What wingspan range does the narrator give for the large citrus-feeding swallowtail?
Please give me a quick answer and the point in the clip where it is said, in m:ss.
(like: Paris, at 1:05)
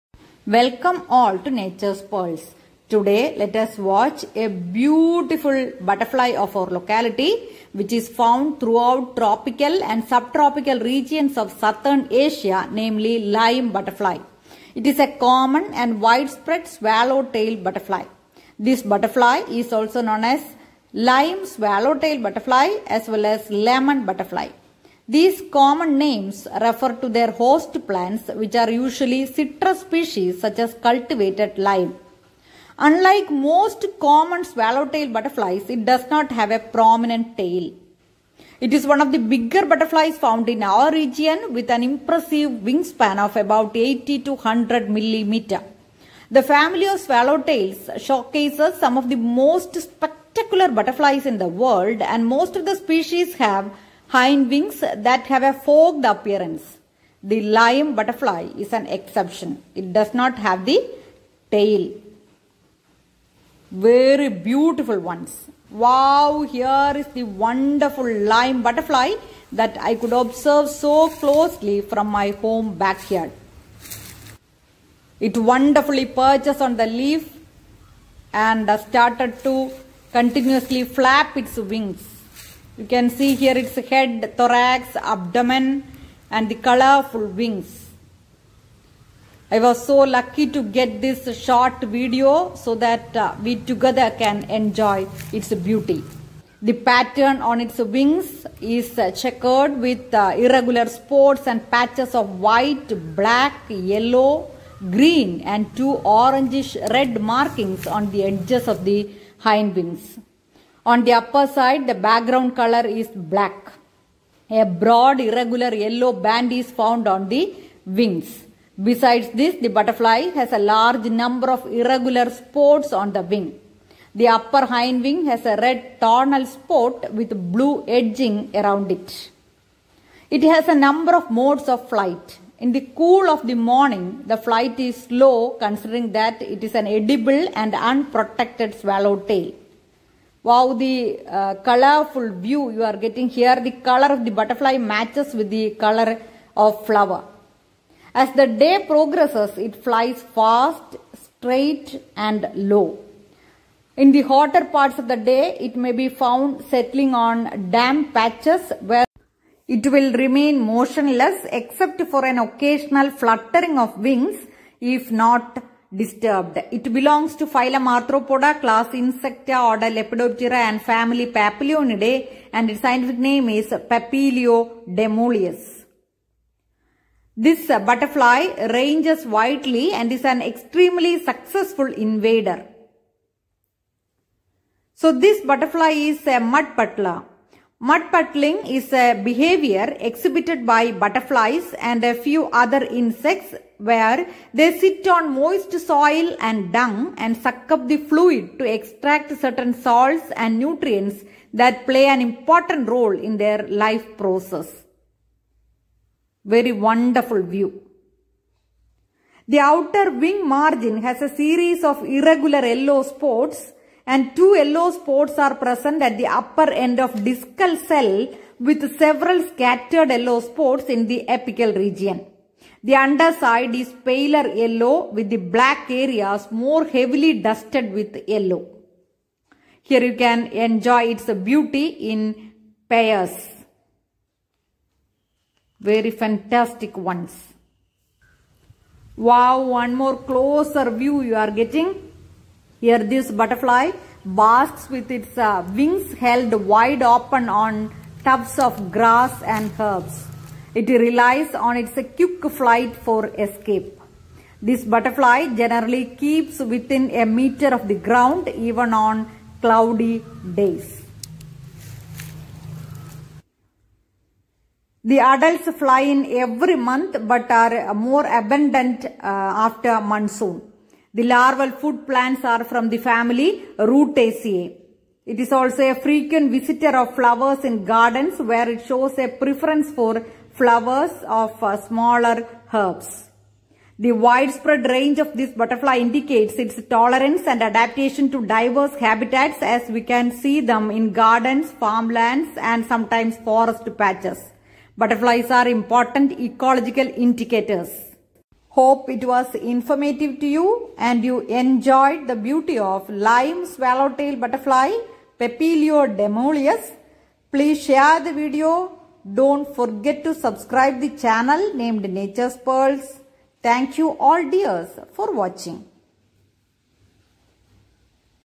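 80 to 100 millimeters, at 0:43.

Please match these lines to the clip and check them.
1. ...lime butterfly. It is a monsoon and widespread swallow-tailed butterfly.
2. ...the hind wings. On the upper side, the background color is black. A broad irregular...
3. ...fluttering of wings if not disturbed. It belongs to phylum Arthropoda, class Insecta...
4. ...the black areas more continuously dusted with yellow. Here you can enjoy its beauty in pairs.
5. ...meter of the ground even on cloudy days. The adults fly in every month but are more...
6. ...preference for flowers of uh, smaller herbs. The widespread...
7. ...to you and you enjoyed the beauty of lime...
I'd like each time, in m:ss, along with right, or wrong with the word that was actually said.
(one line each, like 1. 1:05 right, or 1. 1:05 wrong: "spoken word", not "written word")
1. 0:13 wrong: "common", not "monsoon"
2. 1:48 right
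3. 2:43 right
4. 3:45 wrong: "heavily", not "continuously"
5. 4:17 right
6. 4:39 right
7. 5:00 right.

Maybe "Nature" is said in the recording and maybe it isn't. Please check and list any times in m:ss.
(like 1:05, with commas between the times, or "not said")
0:01, 5:12.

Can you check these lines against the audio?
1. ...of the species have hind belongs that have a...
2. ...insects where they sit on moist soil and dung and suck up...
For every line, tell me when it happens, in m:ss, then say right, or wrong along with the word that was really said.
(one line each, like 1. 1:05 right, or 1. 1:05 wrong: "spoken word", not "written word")
1. 0:52 wrong: "wings", not "belongs"
2. 3:12 right.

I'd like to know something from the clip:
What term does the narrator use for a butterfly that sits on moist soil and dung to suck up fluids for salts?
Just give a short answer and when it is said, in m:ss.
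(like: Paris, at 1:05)
Mud puddler, at 3:06.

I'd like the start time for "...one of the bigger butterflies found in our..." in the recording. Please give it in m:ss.
0:38.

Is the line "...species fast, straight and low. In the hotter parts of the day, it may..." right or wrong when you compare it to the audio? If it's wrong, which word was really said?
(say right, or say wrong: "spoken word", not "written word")
wrong: "flies", not "species".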